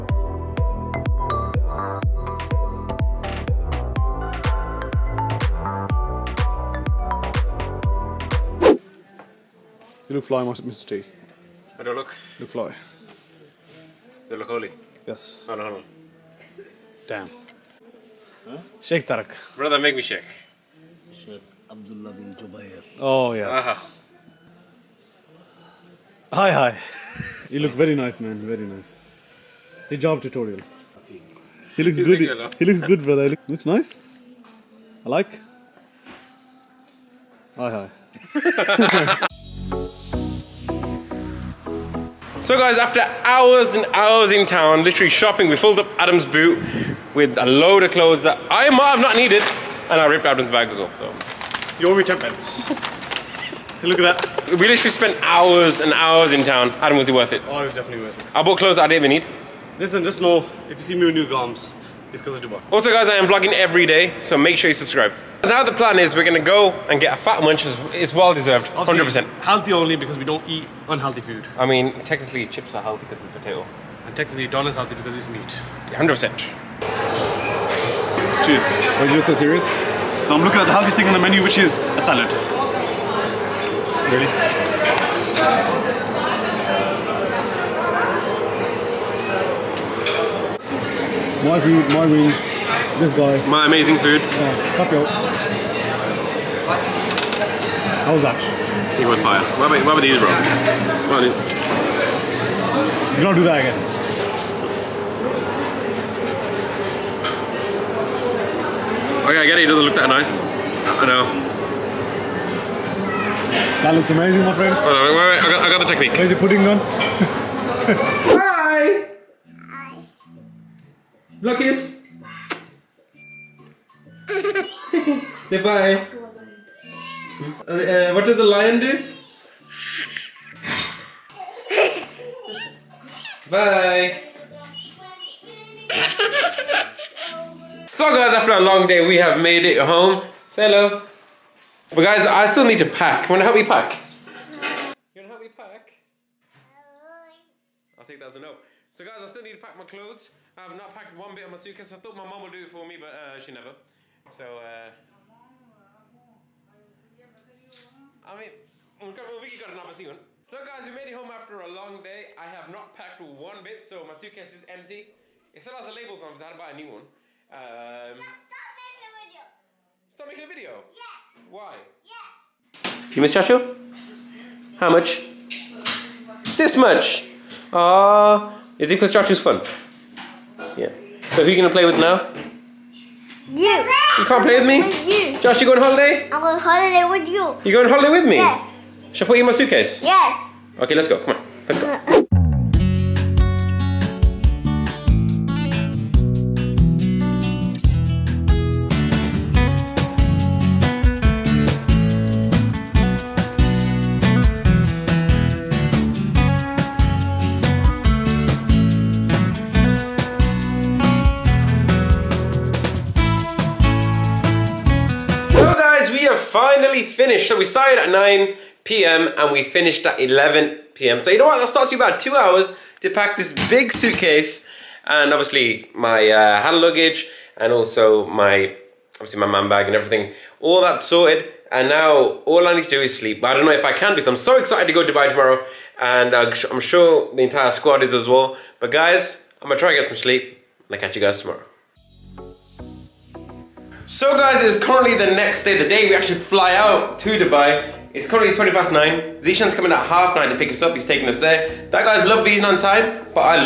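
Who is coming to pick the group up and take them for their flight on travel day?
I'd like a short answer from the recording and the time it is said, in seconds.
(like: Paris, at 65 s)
Zeshan, at 249 s.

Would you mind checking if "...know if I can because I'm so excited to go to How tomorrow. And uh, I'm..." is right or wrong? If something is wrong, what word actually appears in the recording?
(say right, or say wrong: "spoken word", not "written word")
wrong: "Dubai", not "How".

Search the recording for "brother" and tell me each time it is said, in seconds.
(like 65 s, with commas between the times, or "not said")
19 s, 33 s.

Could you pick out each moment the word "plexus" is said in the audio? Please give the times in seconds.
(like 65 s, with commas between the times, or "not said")
not said.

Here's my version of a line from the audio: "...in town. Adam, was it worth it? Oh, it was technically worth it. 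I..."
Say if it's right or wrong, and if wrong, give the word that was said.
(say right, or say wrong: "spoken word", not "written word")
wrong: "definitely", not "technically".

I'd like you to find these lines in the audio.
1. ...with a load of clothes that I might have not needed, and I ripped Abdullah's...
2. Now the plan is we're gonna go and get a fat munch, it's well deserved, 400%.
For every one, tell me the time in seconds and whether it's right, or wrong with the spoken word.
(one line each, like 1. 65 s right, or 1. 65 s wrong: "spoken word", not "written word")
1. 47 s wrong: "Adam", not "Abdullah"
2. 65 s wrong: "100", not "400".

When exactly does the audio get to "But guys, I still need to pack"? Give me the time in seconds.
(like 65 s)
141 s.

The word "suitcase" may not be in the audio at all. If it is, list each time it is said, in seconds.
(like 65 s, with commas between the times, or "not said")
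151 s, 164 s, 189 s, 223 s.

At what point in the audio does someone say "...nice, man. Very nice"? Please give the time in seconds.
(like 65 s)
27 s.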